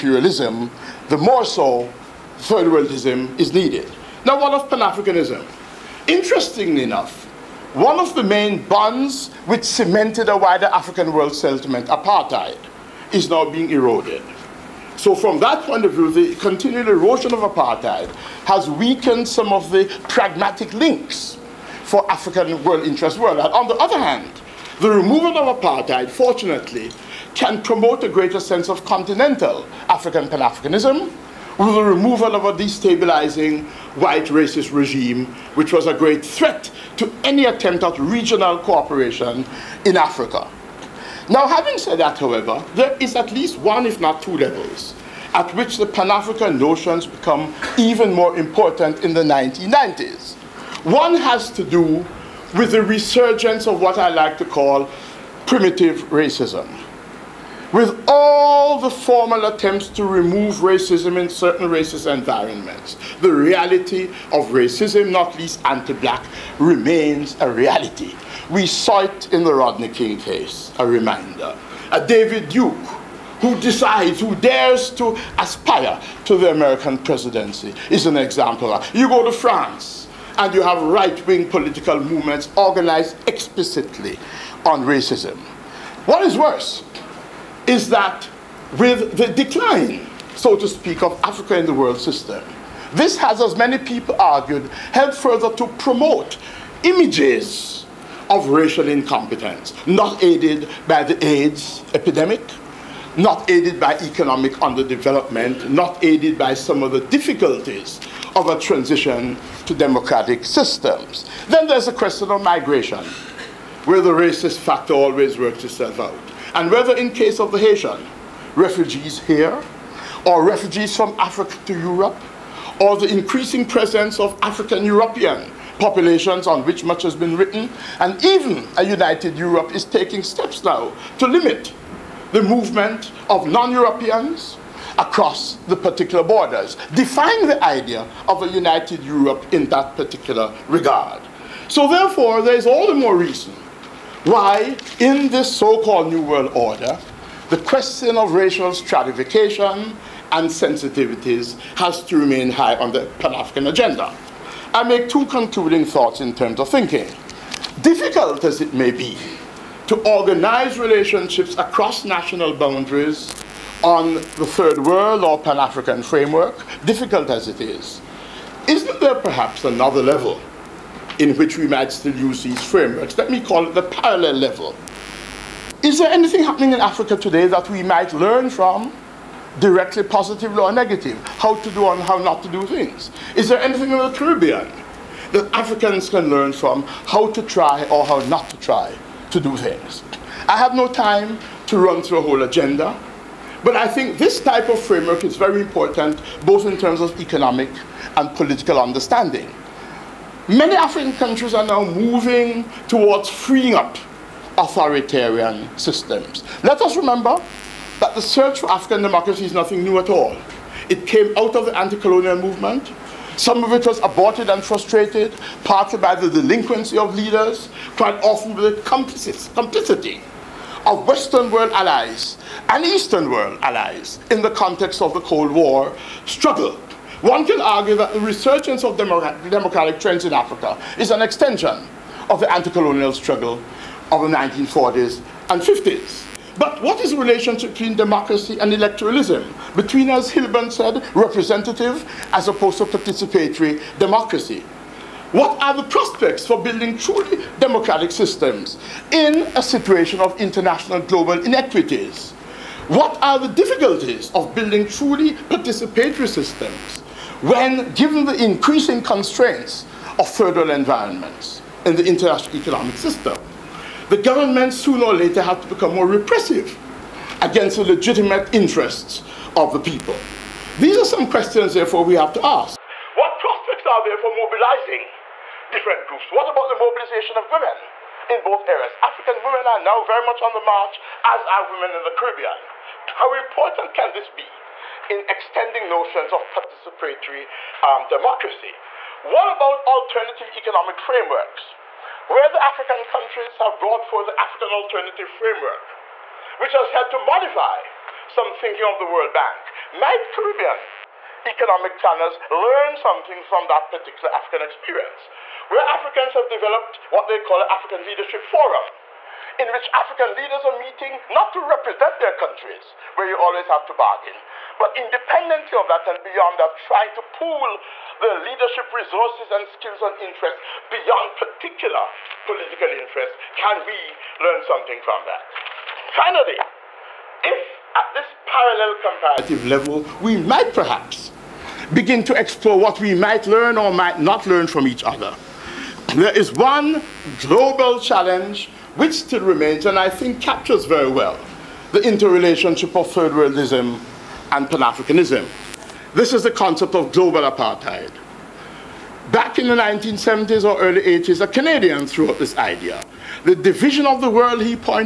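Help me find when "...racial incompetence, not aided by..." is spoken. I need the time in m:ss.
1:38.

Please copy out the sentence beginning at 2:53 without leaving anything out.
Let me call it the parallel level.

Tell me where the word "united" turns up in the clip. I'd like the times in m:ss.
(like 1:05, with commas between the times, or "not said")
2:08, 2:18.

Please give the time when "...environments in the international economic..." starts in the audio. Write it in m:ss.
4:20.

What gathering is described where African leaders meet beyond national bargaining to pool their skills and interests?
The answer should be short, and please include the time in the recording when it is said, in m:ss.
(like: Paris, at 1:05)
African Leadership Forum, at 5:07.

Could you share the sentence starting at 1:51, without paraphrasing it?
Then there's the question of migration, where the racist factor always works itself out.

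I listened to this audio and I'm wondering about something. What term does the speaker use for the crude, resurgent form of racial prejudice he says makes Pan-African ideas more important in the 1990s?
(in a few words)
primitive racism.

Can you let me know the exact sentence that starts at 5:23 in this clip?
Can we learn something from that?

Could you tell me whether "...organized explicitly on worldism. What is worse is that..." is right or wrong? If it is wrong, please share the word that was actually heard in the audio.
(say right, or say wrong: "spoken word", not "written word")
wrong: "racism", not "worldism".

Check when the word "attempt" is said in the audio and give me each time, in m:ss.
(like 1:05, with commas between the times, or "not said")
0:37, 0:59.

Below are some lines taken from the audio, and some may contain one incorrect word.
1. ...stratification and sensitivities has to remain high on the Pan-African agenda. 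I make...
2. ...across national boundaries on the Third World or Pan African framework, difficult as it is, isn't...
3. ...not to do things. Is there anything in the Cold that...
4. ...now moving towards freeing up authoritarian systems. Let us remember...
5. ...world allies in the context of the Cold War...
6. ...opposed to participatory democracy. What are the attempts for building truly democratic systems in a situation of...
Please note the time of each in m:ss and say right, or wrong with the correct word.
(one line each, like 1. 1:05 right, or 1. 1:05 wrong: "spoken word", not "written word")
1. 2:28 right
2. 2:41 right
3. 3:02 wrong: "Caribbean", not "Cold"
4. 3:21 right
5. 3:43 right
6. 4:02 wrong: "prospects", not "attempts".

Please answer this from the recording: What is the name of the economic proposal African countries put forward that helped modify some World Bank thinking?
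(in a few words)
African Alternative Framework.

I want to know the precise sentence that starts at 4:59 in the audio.
Might Caribbean economic planners learn something from that particular African experience?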